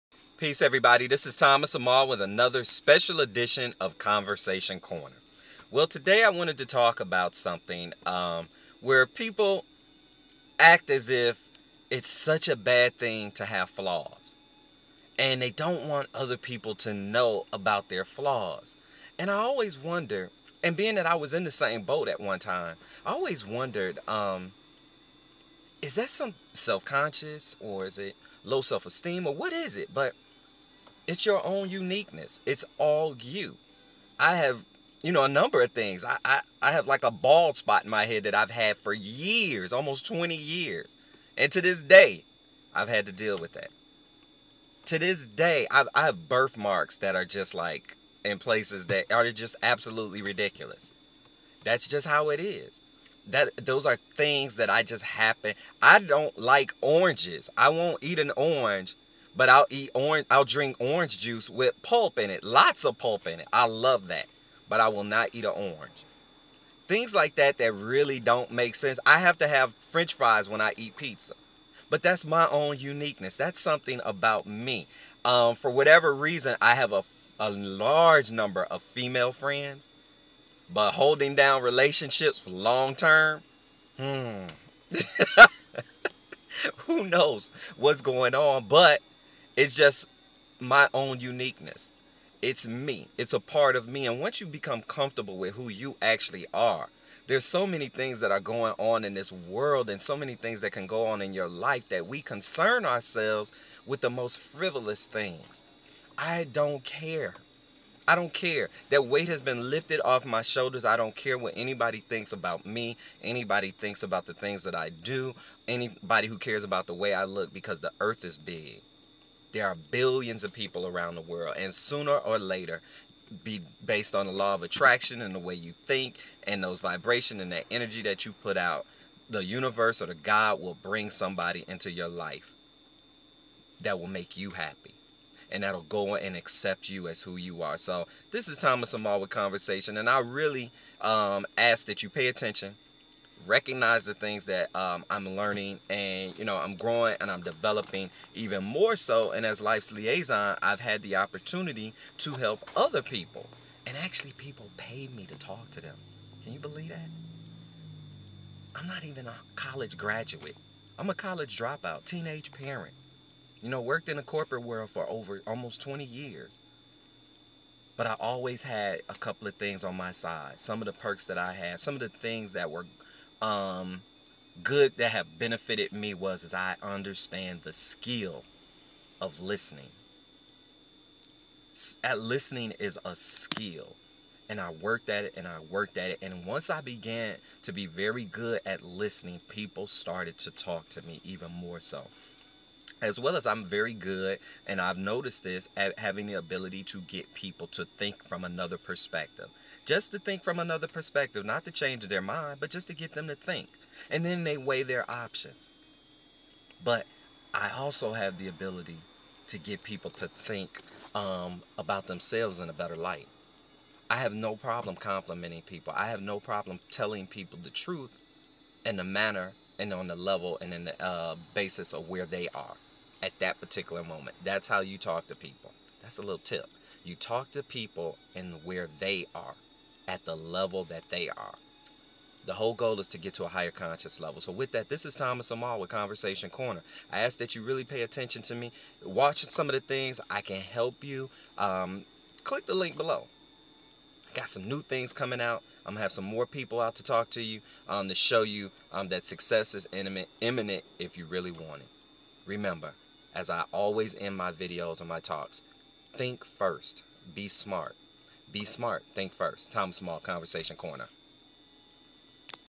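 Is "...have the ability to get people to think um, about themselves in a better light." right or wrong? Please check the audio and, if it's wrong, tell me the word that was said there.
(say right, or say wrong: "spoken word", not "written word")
right.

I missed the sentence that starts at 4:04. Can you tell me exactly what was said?
I got some new things coming out.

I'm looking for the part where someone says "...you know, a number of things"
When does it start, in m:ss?
0:35.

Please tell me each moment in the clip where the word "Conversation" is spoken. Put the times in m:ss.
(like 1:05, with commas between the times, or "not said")
0:03, 2:19, 3:55, 4:20.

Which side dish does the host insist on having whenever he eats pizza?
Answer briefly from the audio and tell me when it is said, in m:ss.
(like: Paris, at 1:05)
french fries, at 1:09.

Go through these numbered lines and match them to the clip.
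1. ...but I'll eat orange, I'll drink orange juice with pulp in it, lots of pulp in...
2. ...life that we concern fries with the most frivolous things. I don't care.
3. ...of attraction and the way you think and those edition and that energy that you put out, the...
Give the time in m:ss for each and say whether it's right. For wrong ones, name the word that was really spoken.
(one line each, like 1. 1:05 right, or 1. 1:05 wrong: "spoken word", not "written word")
1. 0:59 right
2. 1:41 wrong: "ourselves", not "fries"
3. 2:04 wrong: "vibration", not "edition".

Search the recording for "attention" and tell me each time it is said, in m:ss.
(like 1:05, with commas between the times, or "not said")
2:22, 3:58.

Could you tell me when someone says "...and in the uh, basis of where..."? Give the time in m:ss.
3:40.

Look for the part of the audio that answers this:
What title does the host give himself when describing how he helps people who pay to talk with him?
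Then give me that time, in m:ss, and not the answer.
2:29.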